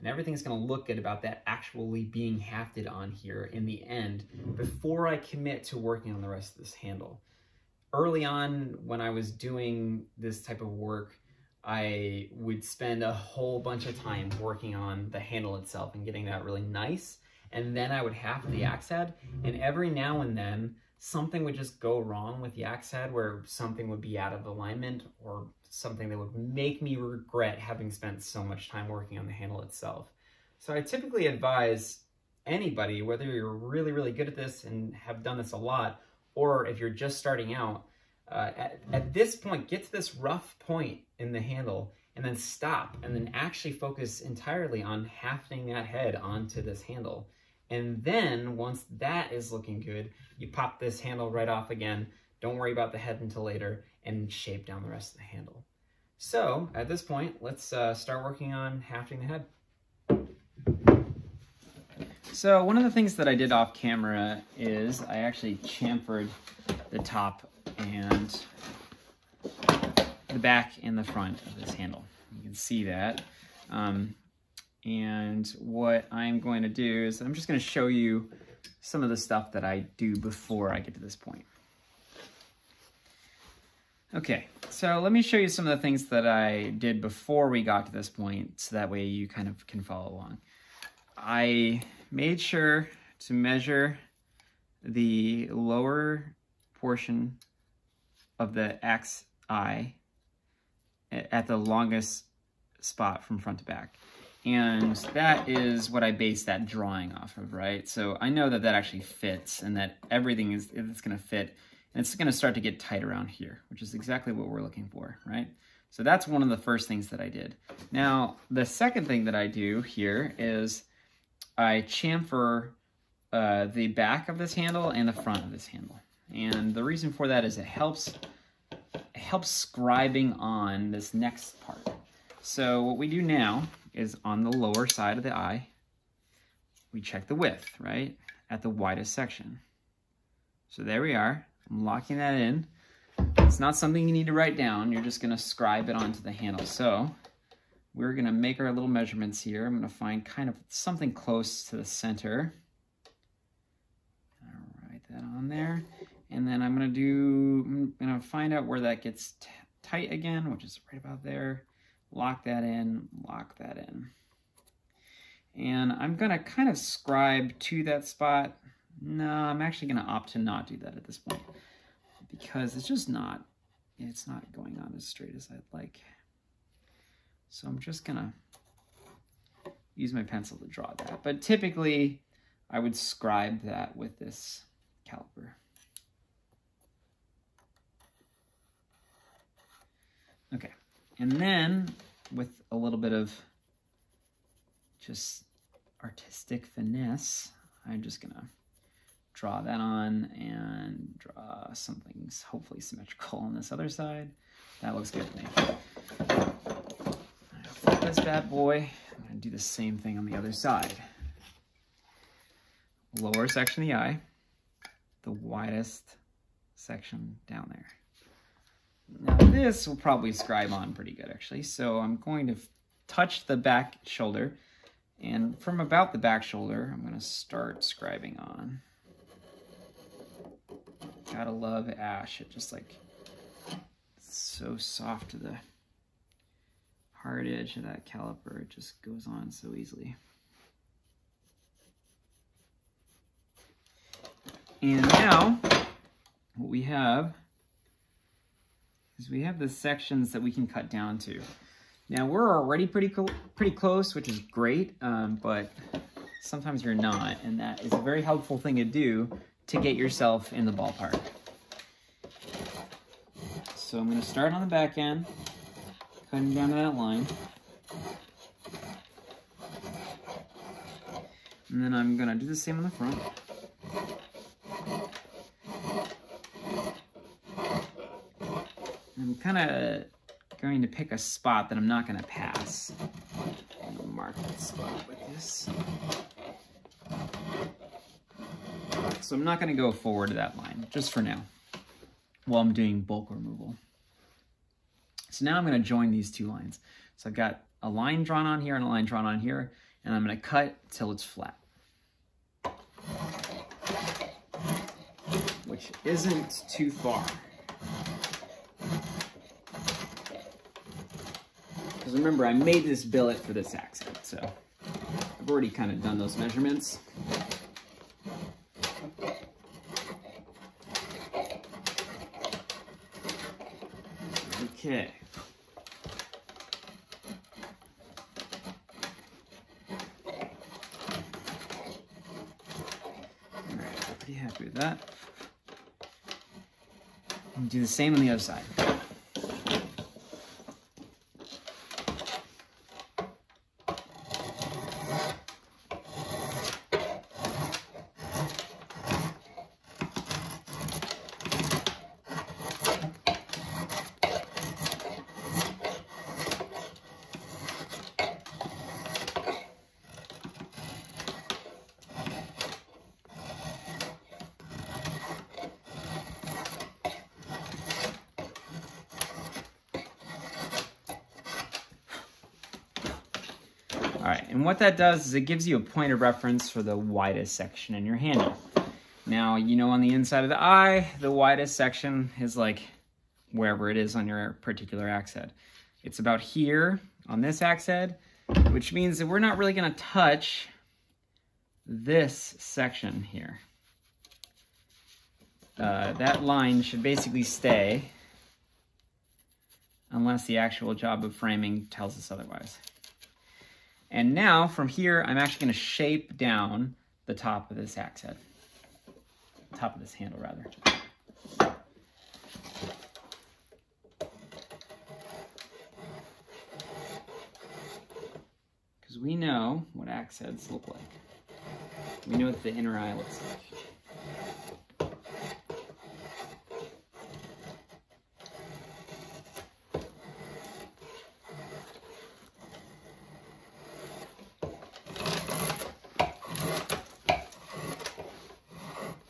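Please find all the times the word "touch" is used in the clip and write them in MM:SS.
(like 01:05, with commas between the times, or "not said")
03:43, 06:29.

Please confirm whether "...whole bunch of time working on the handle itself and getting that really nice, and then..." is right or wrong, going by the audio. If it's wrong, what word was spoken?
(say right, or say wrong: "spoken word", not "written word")
right.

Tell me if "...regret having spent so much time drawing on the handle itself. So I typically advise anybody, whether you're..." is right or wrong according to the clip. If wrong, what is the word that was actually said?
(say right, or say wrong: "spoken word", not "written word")
wrong: "working", not "drawing".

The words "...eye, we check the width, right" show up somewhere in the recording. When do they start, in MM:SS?
02:15.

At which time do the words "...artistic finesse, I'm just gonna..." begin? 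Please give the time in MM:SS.
03:16.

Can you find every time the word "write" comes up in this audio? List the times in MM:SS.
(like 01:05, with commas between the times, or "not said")
02:24, 02:34.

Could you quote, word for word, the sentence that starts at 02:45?
And I'm gonna kind of scribe to that spot.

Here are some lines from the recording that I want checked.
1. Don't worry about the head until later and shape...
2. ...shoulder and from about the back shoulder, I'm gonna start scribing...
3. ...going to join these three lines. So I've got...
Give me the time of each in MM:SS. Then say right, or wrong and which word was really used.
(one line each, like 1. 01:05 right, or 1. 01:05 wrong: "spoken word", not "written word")
1. 00:52 right
2. 03:44 right
3. 04:55 wrong: "two", not "three".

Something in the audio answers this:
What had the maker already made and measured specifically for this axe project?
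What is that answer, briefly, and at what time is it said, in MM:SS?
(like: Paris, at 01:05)
Billet, at 05:13.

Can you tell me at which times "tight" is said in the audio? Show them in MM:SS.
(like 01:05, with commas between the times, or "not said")
01:52, 02:39.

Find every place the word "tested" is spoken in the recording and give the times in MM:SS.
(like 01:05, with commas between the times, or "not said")
not said.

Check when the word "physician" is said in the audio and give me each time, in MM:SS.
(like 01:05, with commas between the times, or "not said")
not said.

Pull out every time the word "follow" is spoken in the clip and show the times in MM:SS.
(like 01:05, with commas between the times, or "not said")
01:29.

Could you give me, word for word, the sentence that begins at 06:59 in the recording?
Because we know what axe heads look like.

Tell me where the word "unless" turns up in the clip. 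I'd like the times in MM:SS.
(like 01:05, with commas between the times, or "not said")
06:40.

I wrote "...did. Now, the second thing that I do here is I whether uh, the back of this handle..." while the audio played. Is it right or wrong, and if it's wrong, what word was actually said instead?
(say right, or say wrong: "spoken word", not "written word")
wrong: "chamfer", not "whether".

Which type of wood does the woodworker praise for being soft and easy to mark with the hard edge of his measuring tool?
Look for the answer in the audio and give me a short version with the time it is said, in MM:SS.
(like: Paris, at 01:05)
Ash, at 03:51.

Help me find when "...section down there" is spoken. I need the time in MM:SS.
03:36.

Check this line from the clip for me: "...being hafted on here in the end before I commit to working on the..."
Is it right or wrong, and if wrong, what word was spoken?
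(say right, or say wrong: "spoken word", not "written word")
right.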